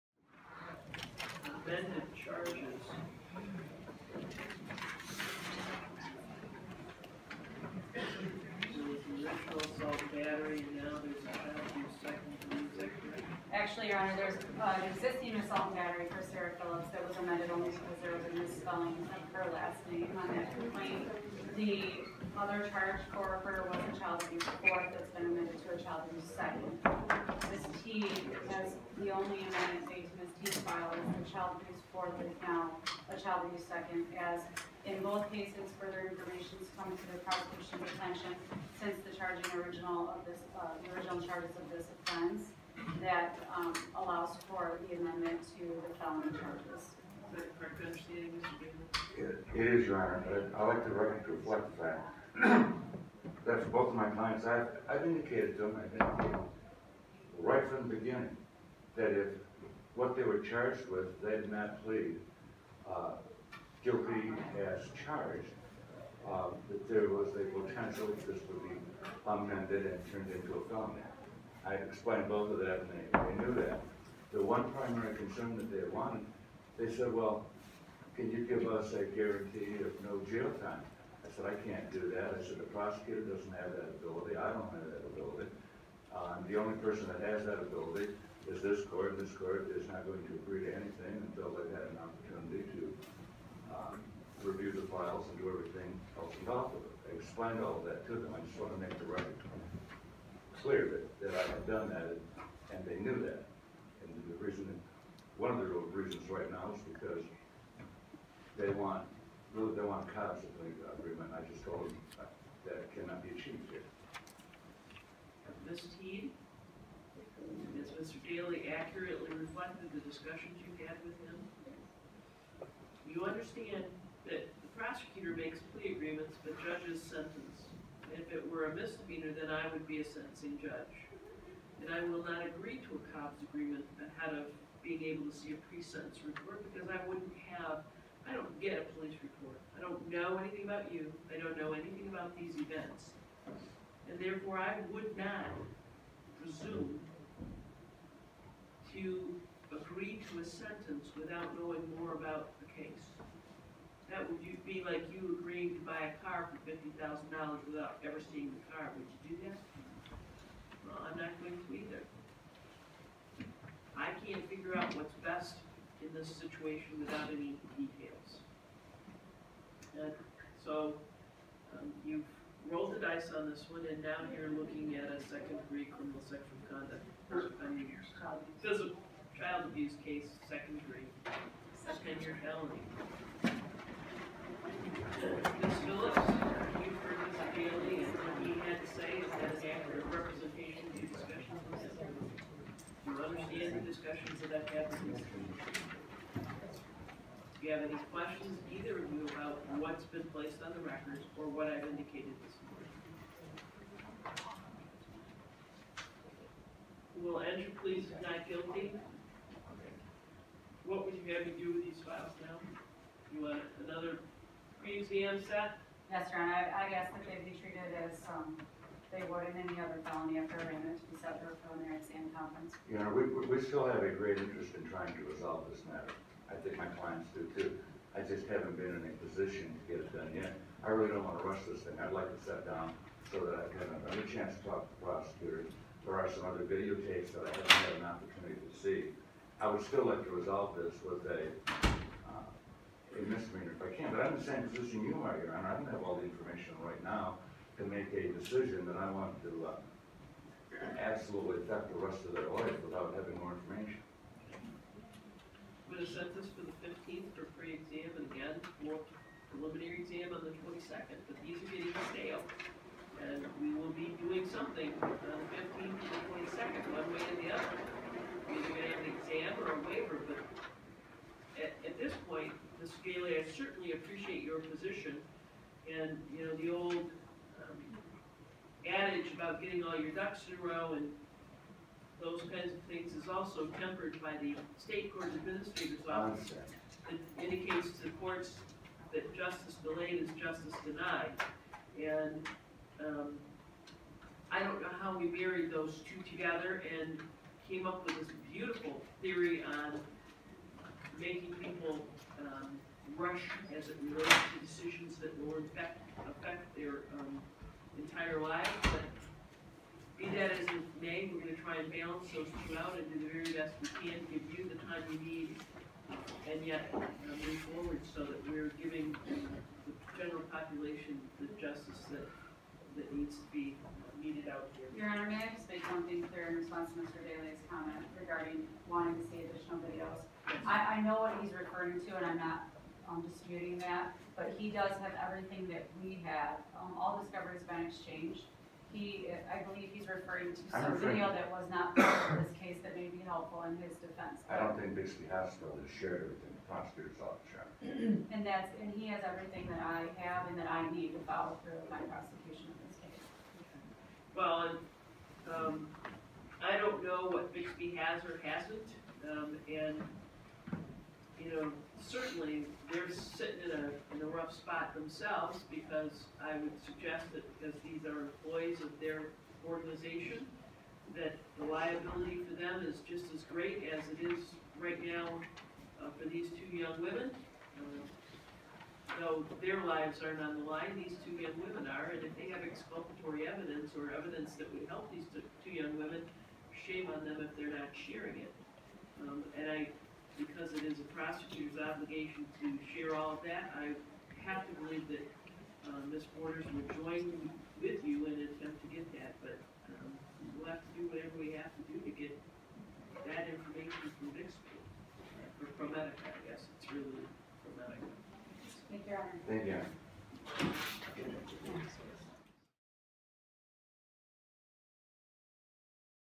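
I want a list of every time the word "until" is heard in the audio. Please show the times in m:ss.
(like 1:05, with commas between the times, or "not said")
1:31.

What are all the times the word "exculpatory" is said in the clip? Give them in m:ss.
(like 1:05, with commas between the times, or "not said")
6:22.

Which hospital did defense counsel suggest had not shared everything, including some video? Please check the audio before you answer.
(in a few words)
Bixby Hospital.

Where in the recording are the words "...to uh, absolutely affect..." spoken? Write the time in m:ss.
4:09.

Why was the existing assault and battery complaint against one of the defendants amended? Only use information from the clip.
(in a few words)
Misspelling of her last name.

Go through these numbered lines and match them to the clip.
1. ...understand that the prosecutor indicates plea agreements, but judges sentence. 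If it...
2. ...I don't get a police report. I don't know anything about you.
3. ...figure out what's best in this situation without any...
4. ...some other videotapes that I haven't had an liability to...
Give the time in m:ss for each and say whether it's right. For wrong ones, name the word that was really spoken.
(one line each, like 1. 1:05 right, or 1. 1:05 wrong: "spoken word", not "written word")
1. 2:03 wrong: "makes", not "indicates"
2. 2:18 right
3. 2:44 right
4. 3:56 wrong: "opportunity", not "liability".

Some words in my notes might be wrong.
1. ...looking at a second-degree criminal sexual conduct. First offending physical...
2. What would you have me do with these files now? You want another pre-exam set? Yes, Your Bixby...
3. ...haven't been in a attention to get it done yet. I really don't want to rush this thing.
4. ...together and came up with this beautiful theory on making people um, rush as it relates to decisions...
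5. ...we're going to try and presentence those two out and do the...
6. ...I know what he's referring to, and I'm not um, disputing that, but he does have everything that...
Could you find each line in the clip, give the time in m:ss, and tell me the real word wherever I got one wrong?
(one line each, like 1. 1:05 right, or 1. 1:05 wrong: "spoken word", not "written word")
1. 2:54 right
2. 3:30 wrong: "Honor", not "Bixby"
3. 3:48 wrong: "position", not "attention"
4. 4:56 right
5. 5:11 wrong: "balance", not "presentence"
6. 5:31 right.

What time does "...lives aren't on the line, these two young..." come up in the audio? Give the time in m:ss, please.
6:19.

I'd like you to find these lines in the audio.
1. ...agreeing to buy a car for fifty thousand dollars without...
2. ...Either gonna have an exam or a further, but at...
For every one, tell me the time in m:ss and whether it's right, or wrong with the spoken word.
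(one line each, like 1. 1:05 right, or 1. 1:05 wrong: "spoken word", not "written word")
1. 2:35 right
2. 4:28 wrong: "waiver", not "further".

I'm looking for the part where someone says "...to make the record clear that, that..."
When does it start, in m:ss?
1:38.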